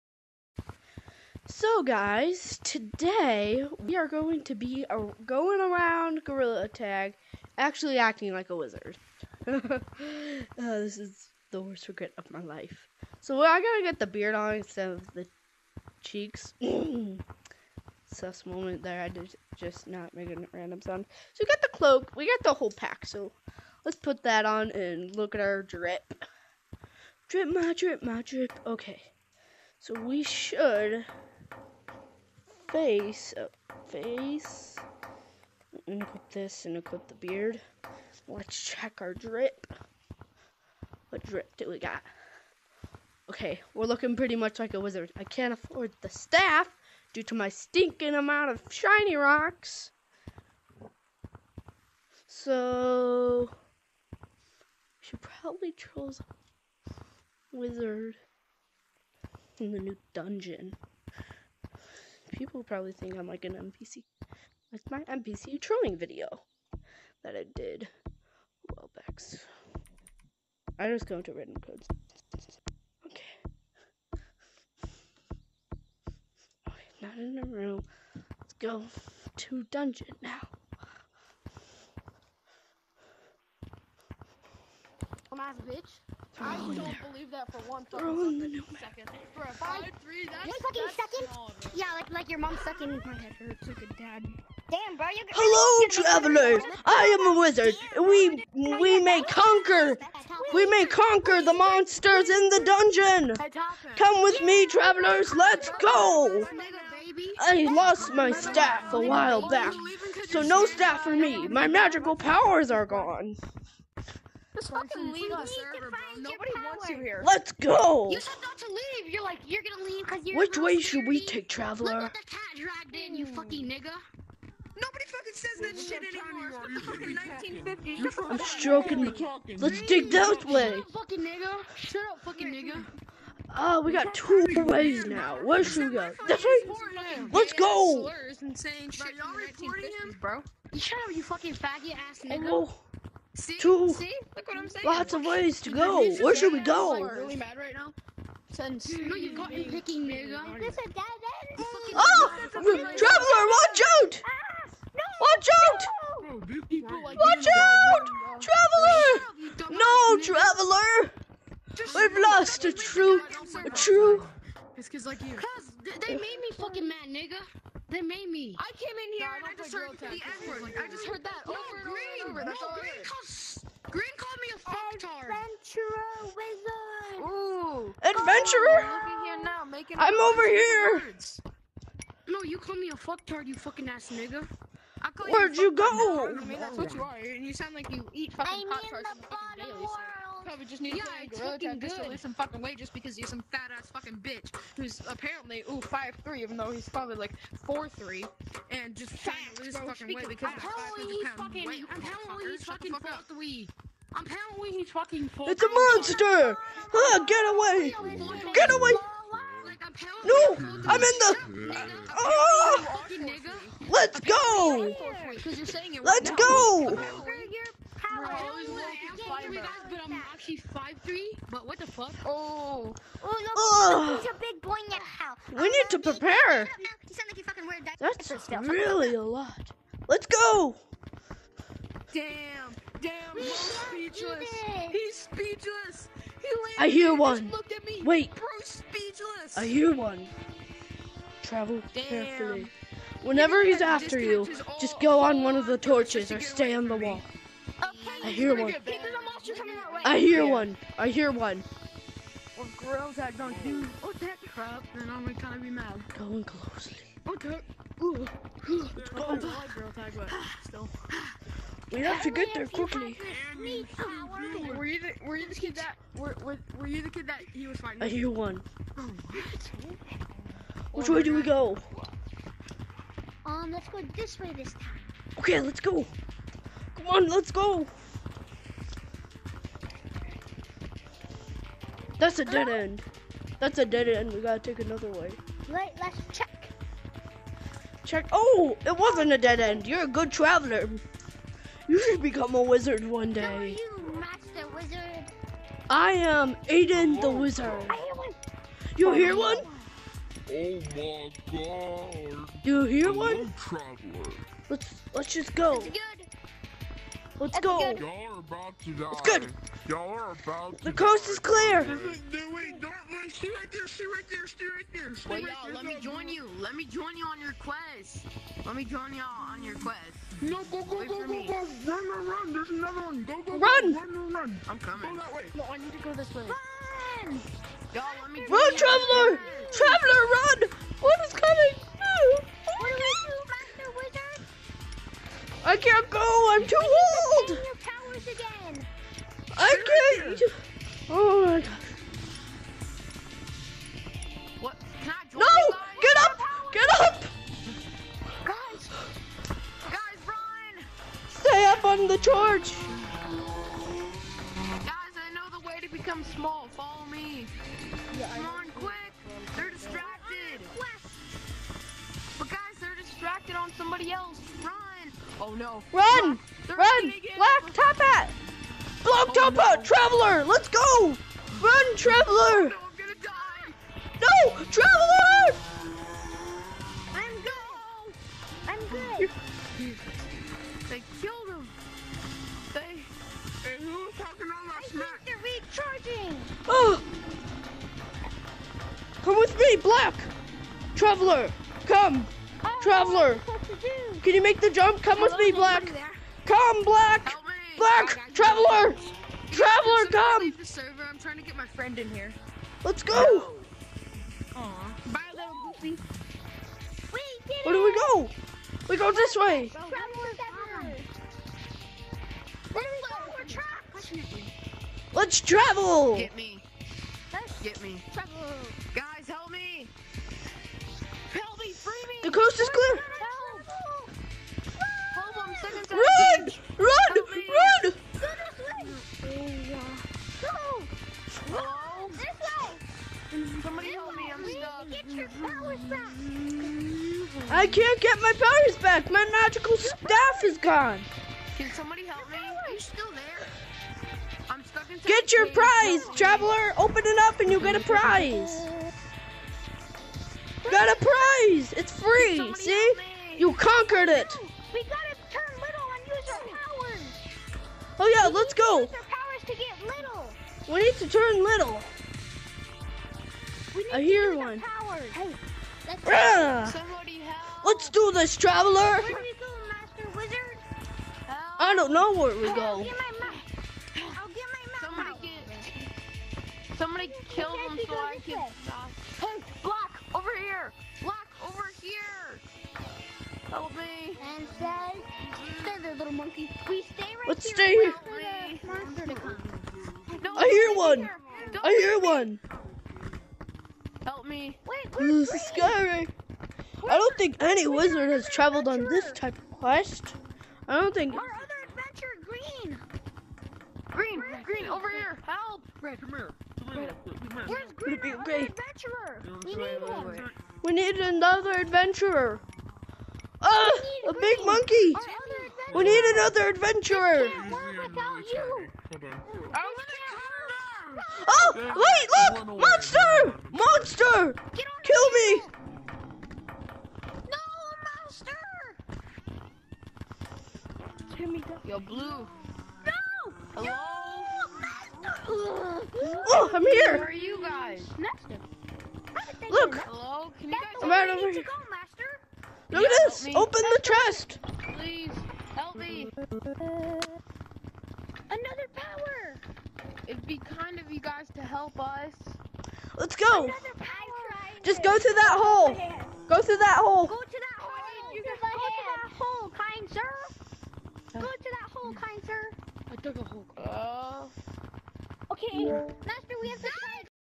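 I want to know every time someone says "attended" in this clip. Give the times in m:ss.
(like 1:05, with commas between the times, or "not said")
not said.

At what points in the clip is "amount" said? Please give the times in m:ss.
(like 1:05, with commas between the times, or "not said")
0:48.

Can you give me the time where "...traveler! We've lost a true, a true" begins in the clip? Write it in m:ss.
2:40.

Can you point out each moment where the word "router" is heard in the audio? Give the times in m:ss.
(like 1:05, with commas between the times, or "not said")
not said.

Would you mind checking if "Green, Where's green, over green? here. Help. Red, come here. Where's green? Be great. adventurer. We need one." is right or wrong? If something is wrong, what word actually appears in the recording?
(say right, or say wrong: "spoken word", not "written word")
right.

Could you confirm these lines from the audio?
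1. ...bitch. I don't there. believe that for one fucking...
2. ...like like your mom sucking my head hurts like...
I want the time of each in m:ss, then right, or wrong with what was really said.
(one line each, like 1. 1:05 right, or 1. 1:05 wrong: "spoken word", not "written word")
1. 1:25 right
2. 1:31 right.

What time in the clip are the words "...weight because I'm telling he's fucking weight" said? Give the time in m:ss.
3:20.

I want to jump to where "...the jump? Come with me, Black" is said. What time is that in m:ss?
6:34.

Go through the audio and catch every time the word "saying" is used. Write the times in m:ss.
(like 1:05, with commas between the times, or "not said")
2:18, 2:24.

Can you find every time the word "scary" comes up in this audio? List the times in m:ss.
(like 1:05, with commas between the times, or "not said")
8:15.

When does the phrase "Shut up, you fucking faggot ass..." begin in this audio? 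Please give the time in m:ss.
2:20.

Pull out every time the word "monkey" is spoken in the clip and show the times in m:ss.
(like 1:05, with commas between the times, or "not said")
8:06, 8:34.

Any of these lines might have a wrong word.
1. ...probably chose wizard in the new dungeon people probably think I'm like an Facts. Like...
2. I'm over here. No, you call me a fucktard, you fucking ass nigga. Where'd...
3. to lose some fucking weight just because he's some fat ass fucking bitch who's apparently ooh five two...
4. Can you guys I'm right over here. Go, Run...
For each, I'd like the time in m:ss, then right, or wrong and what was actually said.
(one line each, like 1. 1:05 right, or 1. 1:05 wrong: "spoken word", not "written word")
1. 0:55 wrong: "NPC", not "Facts"
2. 2:59 right
3. 3:12 wrong: "three", not "two"
4. 9:00 wrong: "Look", not "Run".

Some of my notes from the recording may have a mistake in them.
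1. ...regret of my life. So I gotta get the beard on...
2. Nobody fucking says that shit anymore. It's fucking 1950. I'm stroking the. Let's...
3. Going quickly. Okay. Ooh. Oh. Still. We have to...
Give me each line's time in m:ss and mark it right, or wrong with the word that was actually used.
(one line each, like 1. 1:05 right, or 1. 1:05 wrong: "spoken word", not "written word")
1. 0:11 right
2. 2:04 right
3. 4:16 wrong: "closely", not "quickly".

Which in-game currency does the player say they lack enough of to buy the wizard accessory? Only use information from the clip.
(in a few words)
shiny rocks.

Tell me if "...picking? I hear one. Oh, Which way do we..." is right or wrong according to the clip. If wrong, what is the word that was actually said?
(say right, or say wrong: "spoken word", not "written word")
wrong: "fighting", not "picking".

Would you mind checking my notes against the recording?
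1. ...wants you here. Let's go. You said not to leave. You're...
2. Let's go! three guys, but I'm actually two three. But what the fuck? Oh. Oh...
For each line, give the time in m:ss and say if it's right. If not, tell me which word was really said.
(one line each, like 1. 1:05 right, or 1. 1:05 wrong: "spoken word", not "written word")
1. 1:56 right
2. 3:36 wrong: "five", not "two".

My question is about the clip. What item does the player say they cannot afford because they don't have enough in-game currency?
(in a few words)
the staff.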